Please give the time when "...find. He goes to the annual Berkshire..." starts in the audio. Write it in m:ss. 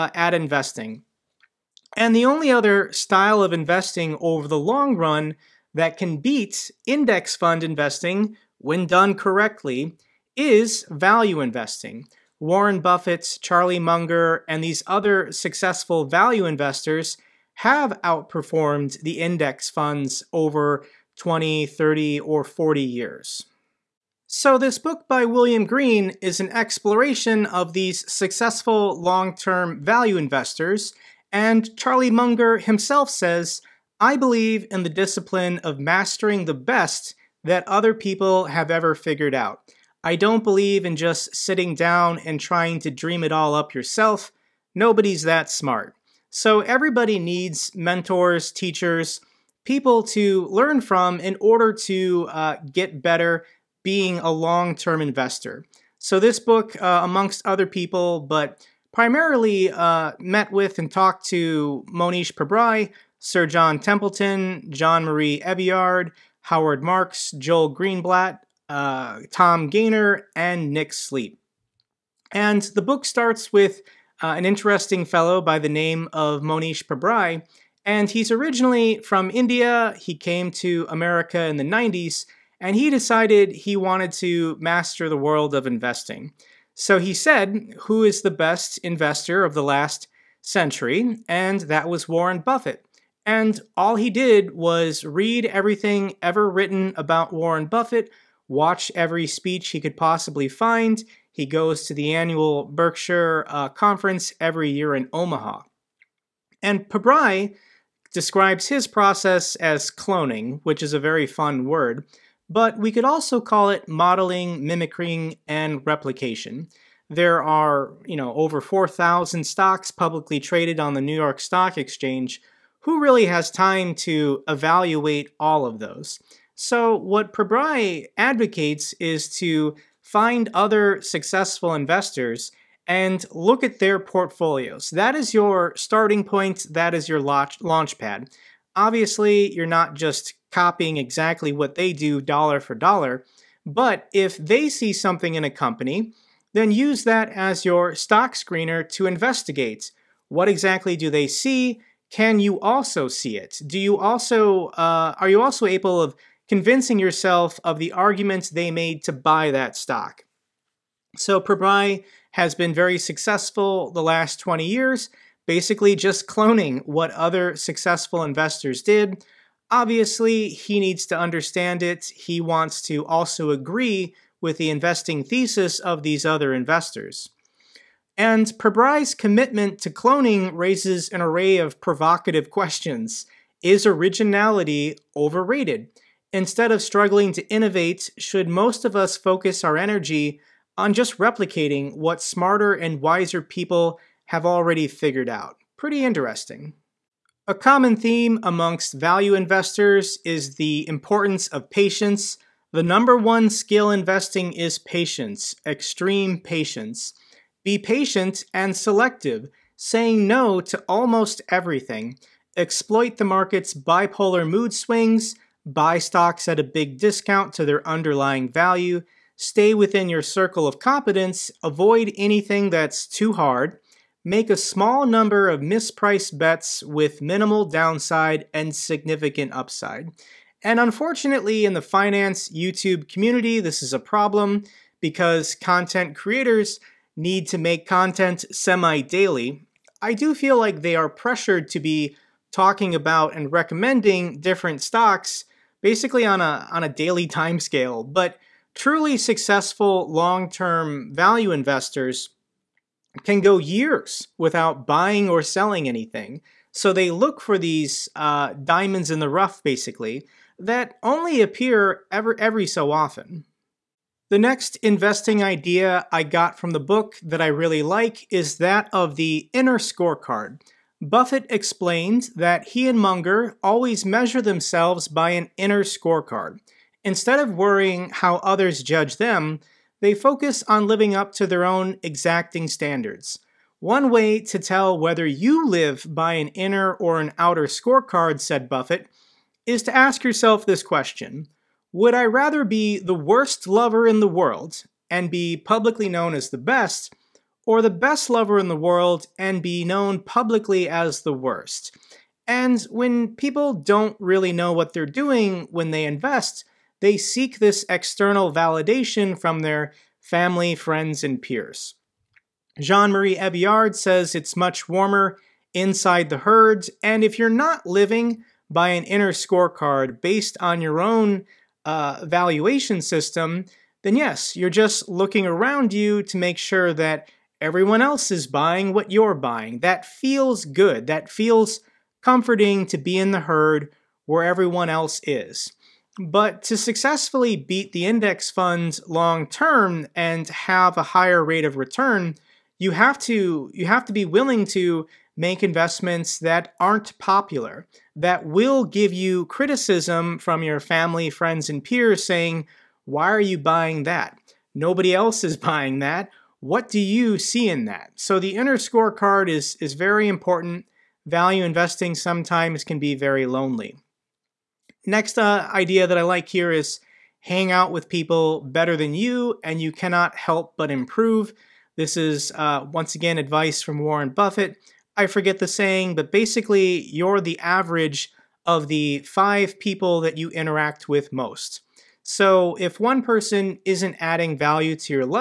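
1:40.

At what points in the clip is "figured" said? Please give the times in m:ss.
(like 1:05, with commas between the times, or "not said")
0:38, 3:14.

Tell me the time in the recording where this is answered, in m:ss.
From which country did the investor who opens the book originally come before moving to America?
1:19.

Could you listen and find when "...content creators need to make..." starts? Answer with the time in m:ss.
3:55.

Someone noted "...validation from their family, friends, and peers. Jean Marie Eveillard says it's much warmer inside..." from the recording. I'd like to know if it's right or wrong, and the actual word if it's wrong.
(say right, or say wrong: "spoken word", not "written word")
right.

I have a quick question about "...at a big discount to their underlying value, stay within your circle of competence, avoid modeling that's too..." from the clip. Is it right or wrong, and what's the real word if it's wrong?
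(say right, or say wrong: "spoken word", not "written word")
wrong: "anything", not "modeling".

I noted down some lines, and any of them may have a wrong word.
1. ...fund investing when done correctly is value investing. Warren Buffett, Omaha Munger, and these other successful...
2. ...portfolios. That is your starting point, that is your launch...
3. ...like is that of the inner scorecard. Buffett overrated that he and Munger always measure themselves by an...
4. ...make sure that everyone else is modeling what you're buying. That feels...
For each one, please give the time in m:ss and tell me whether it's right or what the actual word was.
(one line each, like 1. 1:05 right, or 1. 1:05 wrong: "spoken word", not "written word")
1. 0:07 wrong: "Charlie", not "Omaha"
2. 2:13 right
3. 4:27 wrong: "explained", not "overrated"
4. 5:26 wrong: "buying", not "modeling".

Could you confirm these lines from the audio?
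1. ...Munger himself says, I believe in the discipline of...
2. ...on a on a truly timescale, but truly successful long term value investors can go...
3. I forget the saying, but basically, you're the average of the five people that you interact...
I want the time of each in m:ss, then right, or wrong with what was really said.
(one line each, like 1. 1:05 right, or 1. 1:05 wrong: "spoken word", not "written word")
1. 0:32 right
2. 4:06 wrong: "daily", not "truly"
3. 6:15 right.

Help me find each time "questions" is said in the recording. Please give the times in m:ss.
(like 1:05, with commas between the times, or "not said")
3:02, 4:50.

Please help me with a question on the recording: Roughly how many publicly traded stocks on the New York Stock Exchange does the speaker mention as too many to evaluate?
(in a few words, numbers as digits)
4,000.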